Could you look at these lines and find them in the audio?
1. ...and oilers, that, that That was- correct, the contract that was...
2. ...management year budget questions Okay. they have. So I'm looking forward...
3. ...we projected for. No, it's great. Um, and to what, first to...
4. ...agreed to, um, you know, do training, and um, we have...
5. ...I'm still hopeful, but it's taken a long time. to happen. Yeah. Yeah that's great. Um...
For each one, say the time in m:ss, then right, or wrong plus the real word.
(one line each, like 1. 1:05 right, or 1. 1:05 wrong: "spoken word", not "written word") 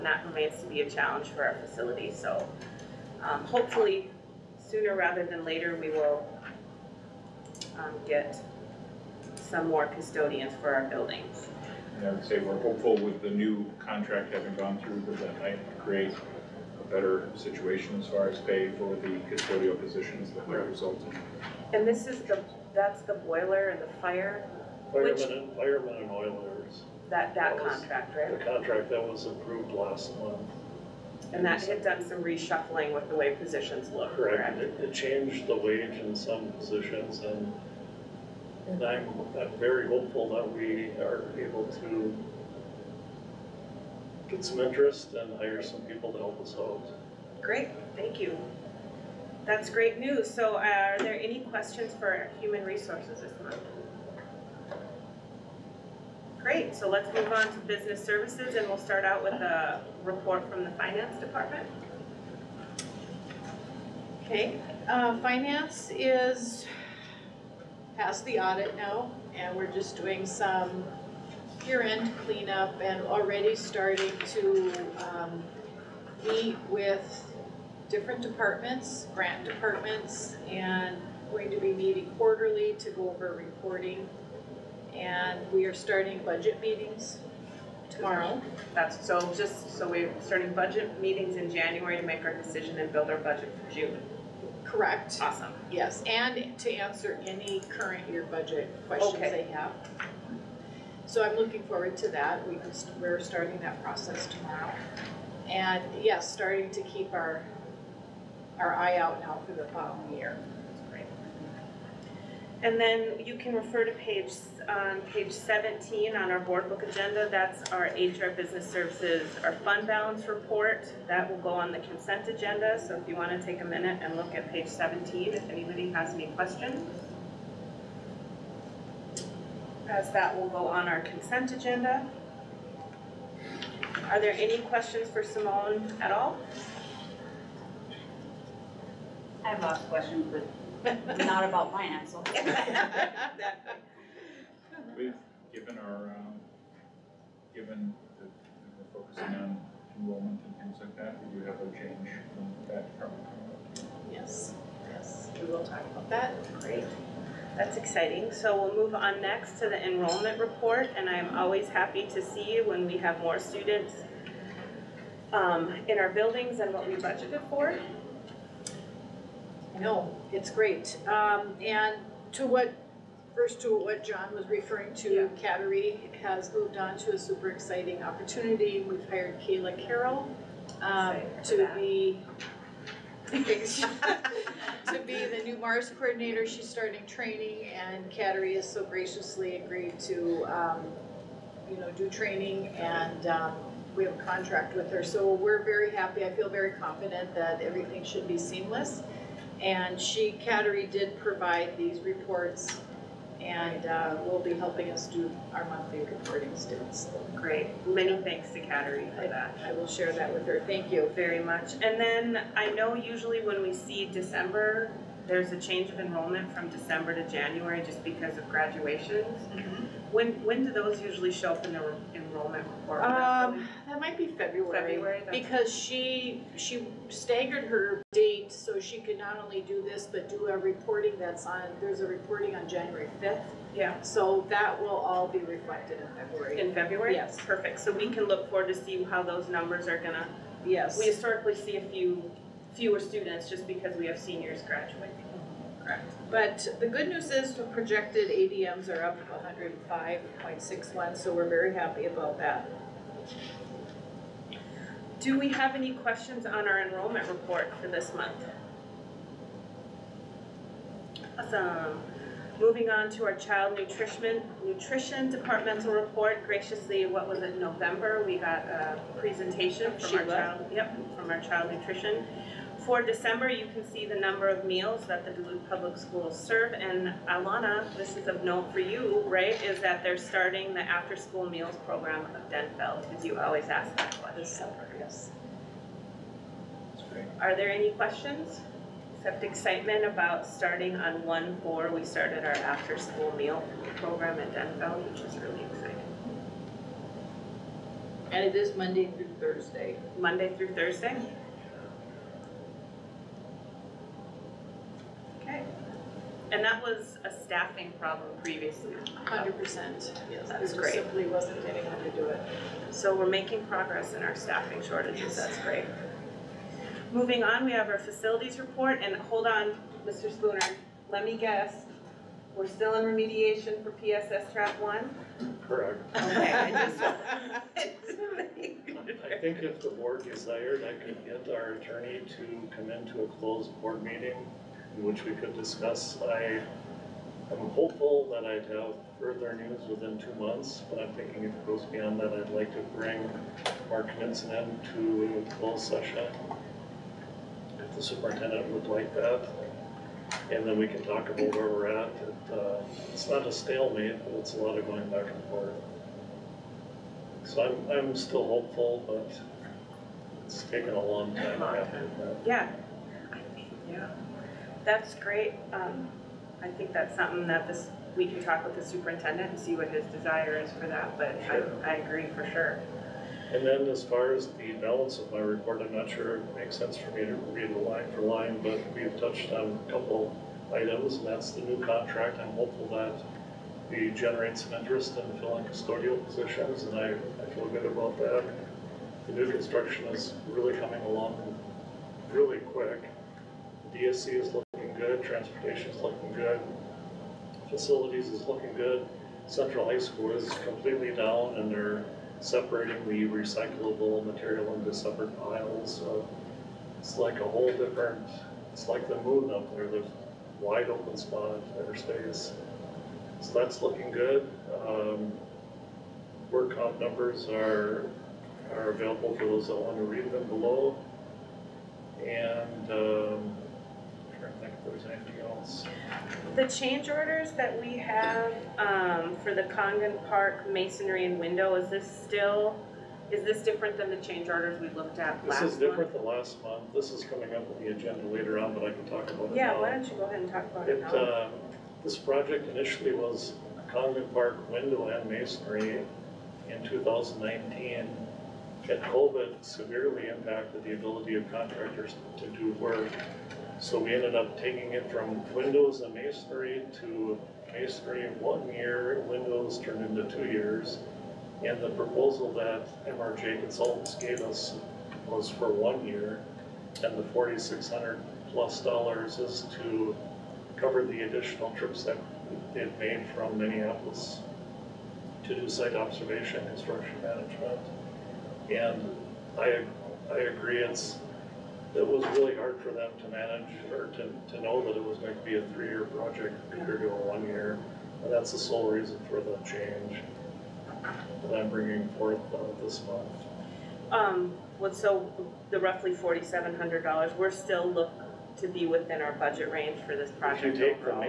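1. 0:26 wrong: "contract", not "correct"
2. 1:37 wrong: "current", not "management"
3. 2:46 wrong: "budgeted", not "projected"
4. 3:09 right
5. 5:57 right.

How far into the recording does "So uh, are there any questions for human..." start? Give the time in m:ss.
0:50.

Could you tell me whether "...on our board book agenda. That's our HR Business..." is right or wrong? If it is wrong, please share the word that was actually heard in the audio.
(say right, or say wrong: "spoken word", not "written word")
right.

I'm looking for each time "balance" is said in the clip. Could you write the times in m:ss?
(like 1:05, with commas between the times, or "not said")
1:59, 6:14.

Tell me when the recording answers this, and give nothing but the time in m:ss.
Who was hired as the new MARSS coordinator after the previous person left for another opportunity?
2:59.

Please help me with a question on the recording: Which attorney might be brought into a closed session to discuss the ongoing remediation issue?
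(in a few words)
Mark Knudsen.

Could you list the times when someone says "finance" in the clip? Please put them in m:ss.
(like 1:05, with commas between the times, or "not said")
1:00, 1:05, 2:21.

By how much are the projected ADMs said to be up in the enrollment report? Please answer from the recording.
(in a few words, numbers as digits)
105.61.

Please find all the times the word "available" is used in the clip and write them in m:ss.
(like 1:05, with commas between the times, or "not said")
6:58.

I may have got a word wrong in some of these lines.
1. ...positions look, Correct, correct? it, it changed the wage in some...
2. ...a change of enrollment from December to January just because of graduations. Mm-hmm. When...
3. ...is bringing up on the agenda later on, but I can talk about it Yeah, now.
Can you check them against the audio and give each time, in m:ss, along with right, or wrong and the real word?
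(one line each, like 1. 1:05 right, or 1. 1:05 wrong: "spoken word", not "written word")
1. 0:33 right
2. 3:35 right
3. 7:17 wrong: "coming", not "bringing".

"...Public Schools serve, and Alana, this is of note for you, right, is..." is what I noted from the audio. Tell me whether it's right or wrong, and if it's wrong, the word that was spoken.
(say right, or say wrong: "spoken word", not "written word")
right.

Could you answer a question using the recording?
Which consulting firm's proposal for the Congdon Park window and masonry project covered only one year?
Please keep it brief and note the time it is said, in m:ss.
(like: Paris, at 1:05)
MRJ Consultants, at 7:43.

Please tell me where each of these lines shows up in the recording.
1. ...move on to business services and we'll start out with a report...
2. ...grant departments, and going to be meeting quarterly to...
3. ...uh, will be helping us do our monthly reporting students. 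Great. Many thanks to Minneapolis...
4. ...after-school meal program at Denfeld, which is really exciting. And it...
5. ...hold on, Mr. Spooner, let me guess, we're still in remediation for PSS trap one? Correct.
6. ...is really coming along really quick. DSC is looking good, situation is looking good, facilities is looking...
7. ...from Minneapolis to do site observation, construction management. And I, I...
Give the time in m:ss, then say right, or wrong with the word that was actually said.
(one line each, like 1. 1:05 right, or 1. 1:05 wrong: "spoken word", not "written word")
1. 0:57 right
2. 1:19 right
3. 3:23 wrong: "Kateri", not "Minneapolis"
4. 4:52 right
5. 5:19 right
6. 6:30 wrong: "transportation", not "situation"
7. 7:53 right.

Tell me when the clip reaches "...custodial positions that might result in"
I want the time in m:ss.
0:19.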